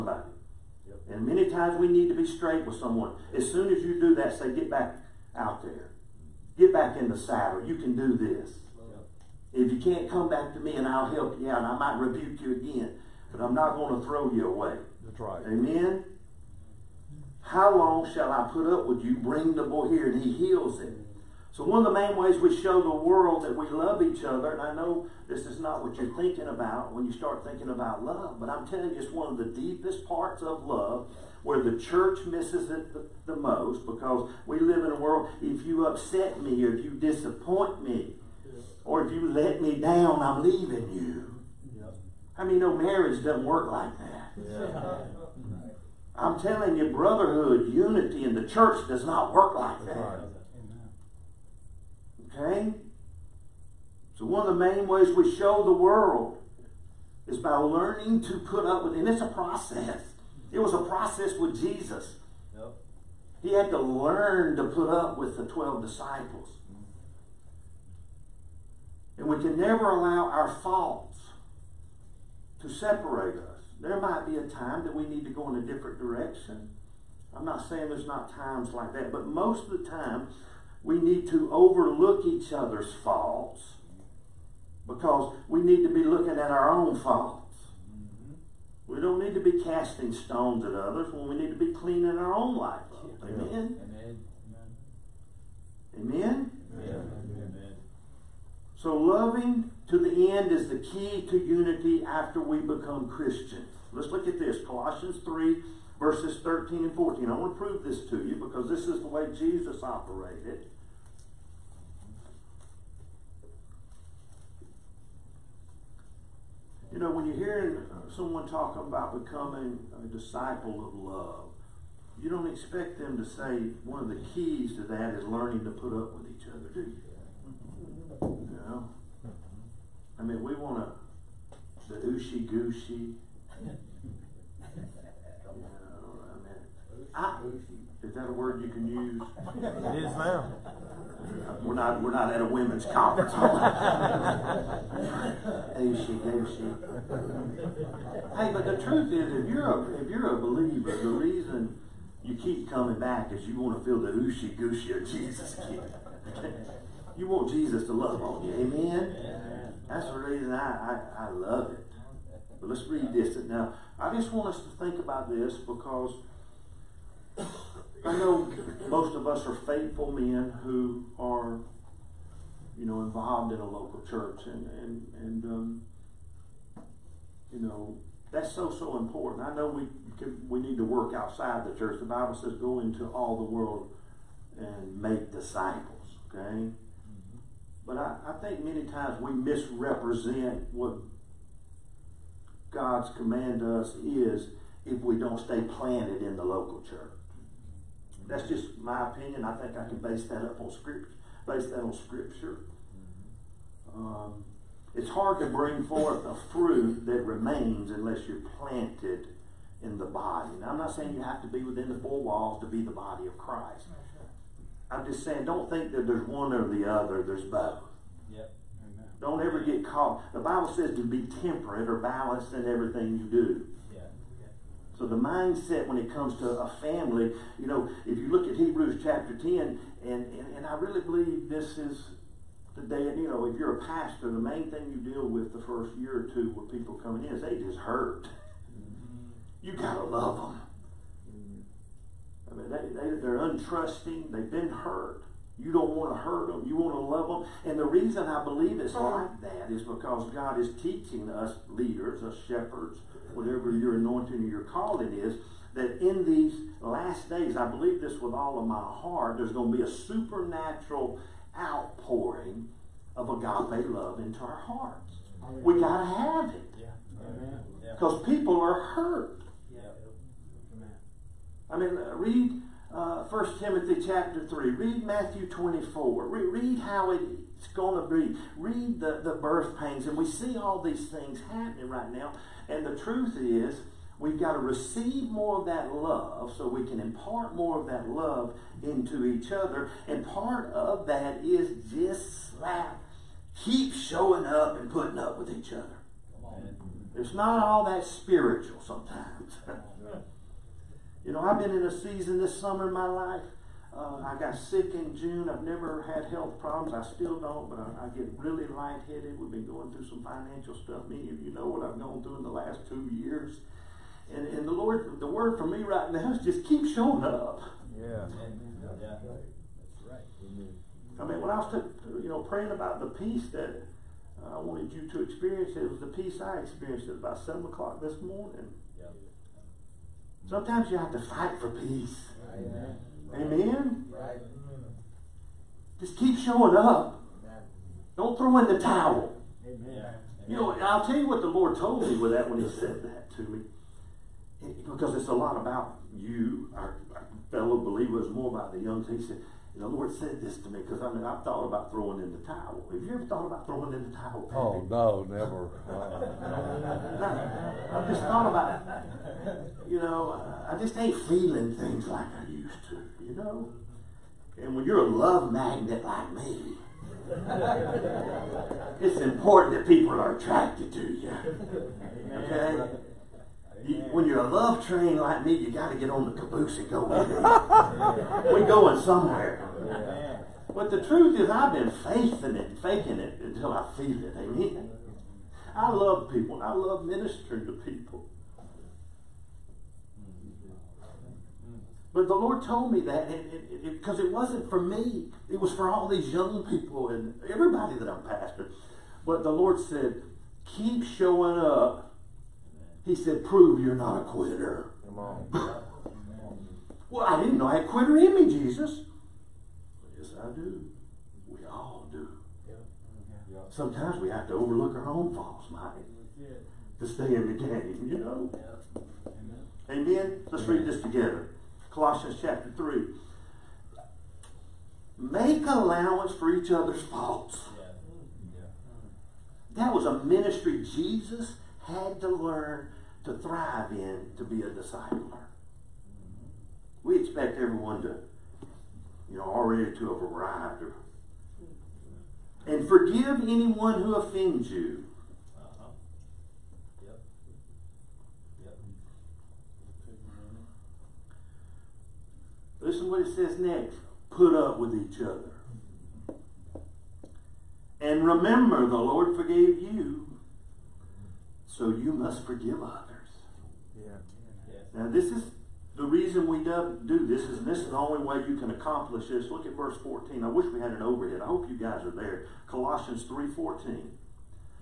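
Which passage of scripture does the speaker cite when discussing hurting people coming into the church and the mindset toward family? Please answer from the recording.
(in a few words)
Hebrews chapter 10.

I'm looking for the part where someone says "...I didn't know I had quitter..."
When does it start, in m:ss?
6:47.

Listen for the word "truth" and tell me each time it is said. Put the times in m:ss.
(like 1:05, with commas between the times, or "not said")
2:28, 4:42, 6:21.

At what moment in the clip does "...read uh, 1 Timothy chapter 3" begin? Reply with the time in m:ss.
4:32.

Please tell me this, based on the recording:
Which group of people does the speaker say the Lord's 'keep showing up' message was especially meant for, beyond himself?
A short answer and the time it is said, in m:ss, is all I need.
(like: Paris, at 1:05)
young people, at 6:36.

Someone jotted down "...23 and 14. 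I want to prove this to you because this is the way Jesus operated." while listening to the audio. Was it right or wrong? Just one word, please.
wrong.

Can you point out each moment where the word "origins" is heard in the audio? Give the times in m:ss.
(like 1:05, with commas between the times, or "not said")
not said.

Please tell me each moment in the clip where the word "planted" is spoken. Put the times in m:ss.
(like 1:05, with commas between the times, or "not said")
3:15, 3:28.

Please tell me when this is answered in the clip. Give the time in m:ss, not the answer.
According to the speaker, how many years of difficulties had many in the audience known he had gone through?
5:12.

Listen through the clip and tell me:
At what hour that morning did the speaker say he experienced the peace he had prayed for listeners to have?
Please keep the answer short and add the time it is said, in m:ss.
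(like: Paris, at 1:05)
7 o'clock, at 5:27.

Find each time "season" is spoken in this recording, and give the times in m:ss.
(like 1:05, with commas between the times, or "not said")
5:01.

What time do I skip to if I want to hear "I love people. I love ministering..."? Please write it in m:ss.
6:25.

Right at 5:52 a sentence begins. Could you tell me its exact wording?
Have you ever thought about throwing in the towel?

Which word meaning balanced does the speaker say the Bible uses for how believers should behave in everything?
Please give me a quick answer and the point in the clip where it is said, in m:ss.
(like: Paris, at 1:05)
temperate, at 3:41.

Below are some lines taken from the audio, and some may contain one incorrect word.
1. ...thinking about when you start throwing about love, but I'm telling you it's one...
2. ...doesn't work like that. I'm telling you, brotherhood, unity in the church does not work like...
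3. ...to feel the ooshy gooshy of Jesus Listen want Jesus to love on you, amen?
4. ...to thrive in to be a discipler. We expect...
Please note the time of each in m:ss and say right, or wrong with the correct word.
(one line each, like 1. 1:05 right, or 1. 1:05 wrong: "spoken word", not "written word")
1. 0:26 wrong: "thinking", not "throwing"
2. 0:43 right
3. 2:33 wrong: "You", not "Listen"
4. 7:13 right.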